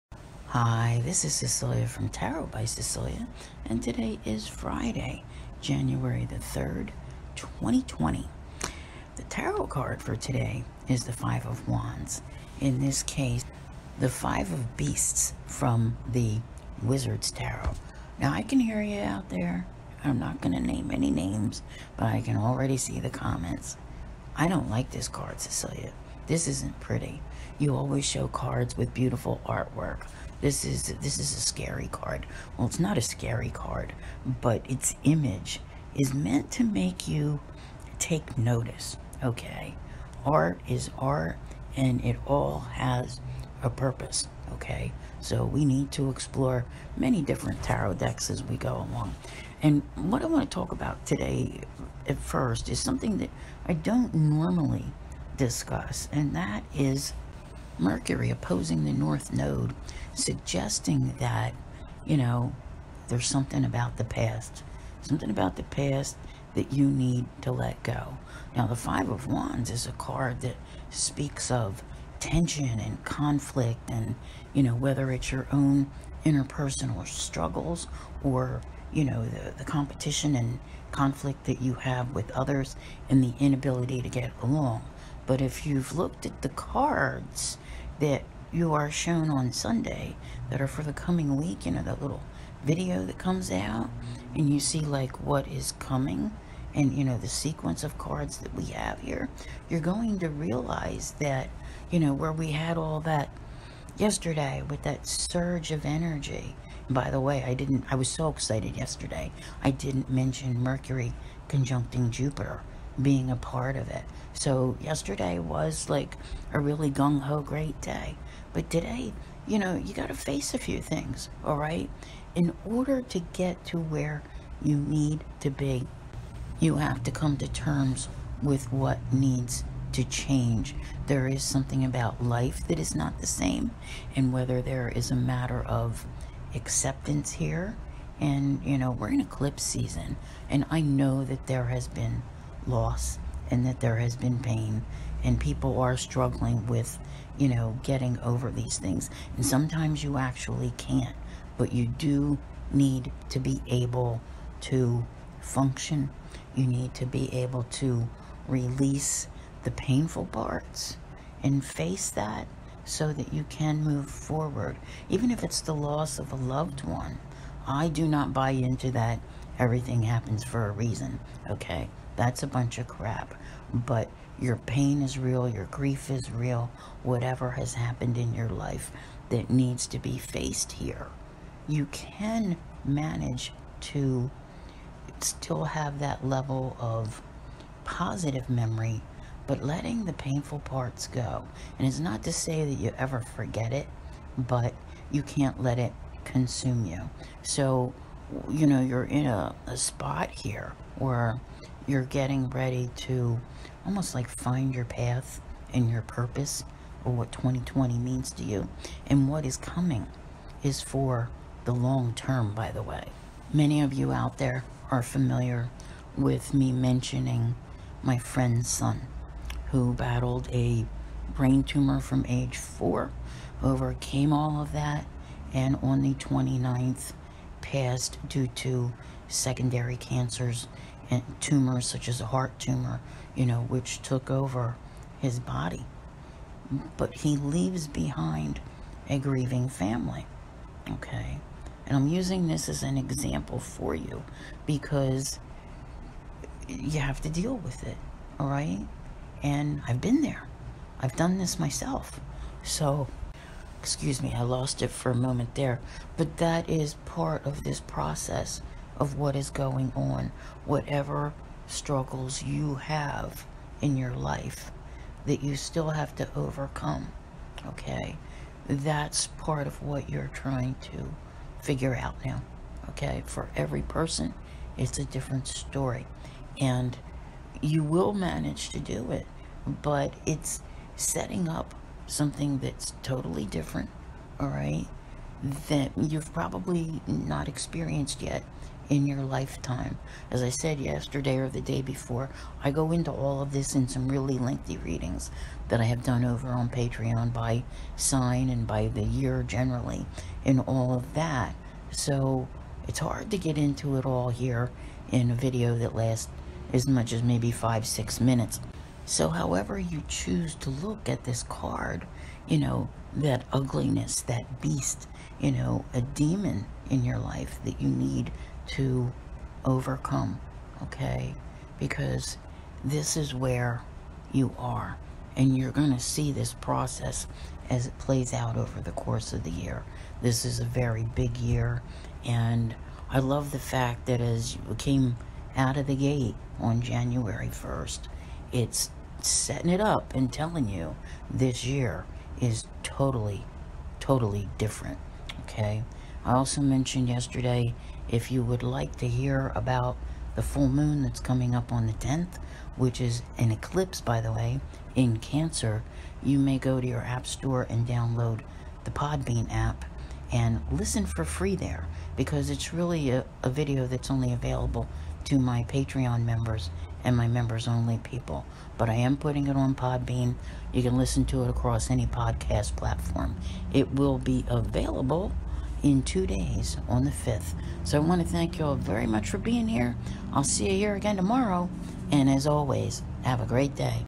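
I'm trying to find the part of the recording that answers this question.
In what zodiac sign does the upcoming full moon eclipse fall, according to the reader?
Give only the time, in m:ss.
5:55.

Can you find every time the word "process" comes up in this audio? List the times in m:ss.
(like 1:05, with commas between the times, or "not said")
4:17, 5:26.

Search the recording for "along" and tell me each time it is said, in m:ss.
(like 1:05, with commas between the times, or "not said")
0:48, 1:24.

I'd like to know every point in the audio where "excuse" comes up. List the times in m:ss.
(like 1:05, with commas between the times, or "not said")
4:13.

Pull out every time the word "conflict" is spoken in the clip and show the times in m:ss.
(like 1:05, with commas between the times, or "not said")
1:13, 1:20.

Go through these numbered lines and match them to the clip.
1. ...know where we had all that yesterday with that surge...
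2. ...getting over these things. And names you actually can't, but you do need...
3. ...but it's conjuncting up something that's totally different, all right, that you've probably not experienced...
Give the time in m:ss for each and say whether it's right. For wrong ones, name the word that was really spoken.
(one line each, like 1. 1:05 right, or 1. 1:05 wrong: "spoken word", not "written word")
1. 1:41 right
2. 2:27 wrong: "sometimes", not "names"
3. 4:39 wrong: "setting", not "conjuncting".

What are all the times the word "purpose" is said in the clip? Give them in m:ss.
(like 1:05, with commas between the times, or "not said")
0:43, 3:26.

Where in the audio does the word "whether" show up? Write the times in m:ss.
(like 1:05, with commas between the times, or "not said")
1:14, 2:14.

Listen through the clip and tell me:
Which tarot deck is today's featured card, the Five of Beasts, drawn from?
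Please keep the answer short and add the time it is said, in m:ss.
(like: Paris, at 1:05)
Wizard's Tarot, at 0:16.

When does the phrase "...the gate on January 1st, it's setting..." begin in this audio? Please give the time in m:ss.
5:35.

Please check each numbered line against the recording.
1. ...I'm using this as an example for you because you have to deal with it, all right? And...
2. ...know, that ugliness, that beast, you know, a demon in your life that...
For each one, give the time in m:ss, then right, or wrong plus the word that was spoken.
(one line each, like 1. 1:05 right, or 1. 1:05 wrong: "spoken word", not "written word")
1. 4:01 right
2. 5:12 right.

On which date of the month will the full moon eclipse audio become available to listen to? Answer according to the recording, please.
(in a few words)
the 5th.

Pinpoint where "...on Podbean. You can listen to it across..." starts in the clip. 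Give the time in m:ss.
6:09.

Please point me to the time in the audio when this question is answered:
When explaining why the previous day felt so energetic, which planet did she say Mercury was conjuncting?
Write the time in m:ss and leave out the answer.
1:52.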